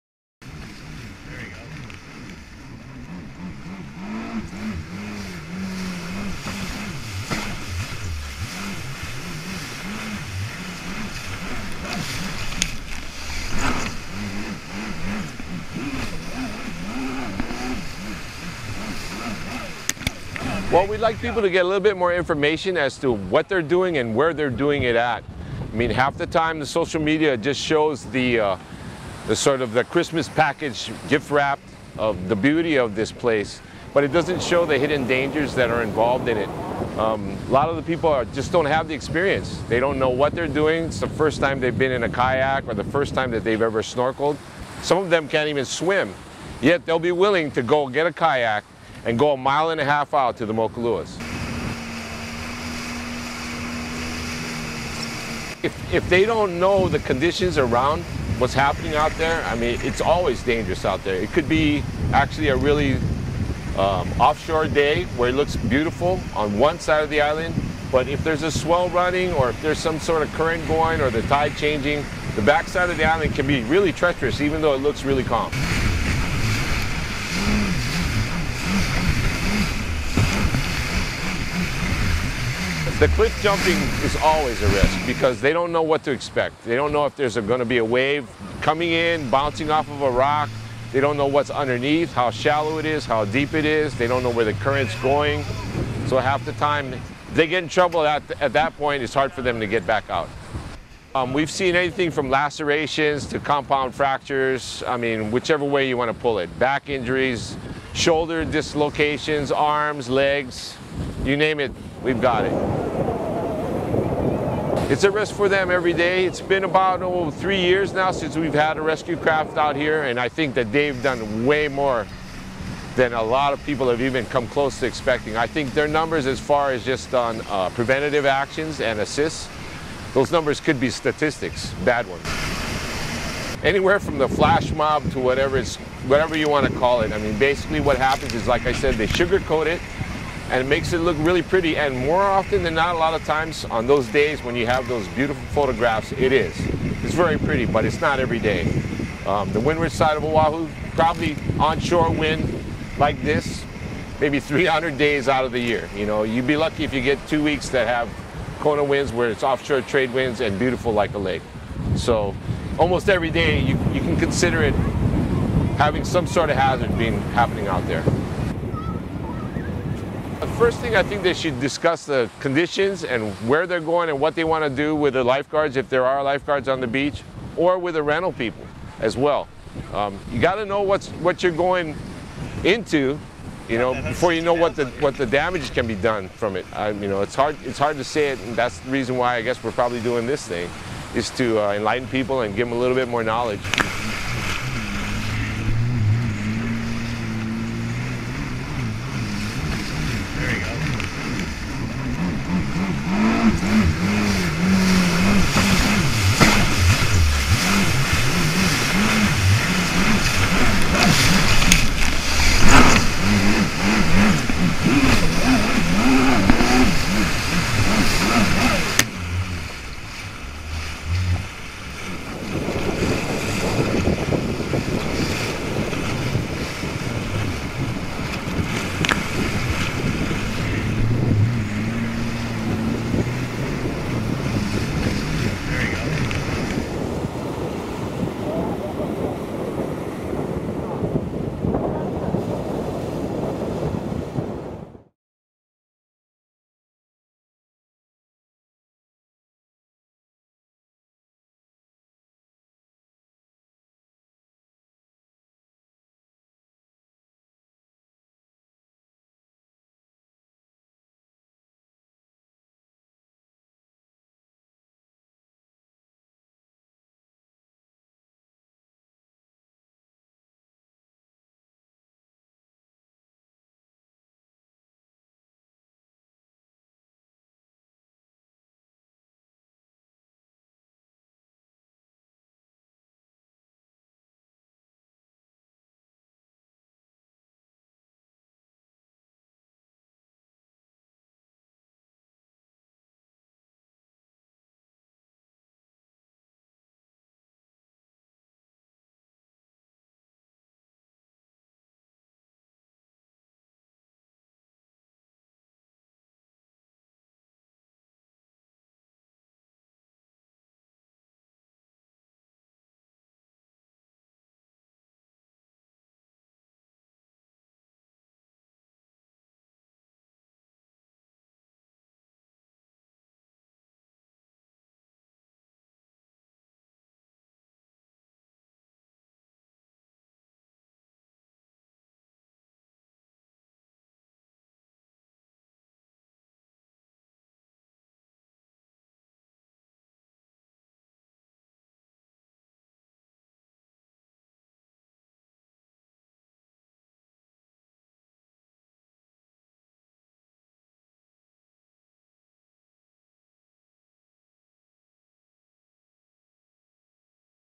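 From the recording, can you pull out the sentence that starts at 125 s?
I think their numbers as far as just on uh, preventative actions and assists, those numbers could be statistics, bad ones.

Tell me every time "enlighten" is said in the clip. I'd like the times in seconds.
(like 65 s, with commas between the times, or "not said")
191 s.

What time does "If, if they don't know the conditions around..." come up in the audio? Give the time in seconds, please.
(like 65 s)
55 s.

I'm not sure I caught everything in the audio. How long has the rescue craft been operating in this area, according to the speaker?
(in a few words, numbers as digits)
3 years.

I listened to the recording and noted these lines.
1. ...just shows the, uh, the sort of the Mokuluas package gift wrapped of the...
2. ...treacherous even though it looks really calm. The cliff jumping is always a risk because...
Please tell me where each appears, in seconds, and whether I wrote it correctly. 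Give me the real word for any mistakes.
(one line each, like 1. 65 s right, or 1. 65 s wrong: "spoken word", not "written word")
1. 27 s wrong: "Christmas", not "Mokuluas"
2. 73 s right.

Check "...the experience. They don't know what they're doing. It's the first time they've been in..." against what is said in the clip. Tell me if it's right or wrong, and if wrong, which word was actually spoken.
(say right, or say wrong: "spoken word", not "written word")
right.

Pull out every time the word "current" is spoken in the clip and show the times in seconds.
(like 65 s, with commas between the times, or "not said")
70 s, 94 s.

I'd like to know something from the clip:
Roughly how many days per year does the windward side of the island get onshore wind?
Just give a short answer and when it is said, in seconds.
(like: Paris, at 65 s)
300, at 154 s.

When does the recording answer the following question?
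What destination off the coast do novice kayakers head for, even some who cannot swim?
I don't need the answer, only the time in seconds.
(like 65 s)
50 s.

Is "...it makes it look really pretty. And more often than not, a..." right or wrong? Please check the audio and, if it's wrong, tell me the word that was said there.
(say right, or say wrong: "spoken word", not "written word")
right.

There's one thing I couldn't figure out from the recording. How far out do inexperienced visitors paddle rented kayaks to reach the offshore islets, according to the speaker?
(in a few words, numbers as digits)
a mile and a half.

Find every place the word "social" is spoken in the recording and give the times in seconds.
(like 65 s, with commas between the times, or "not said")
26 s.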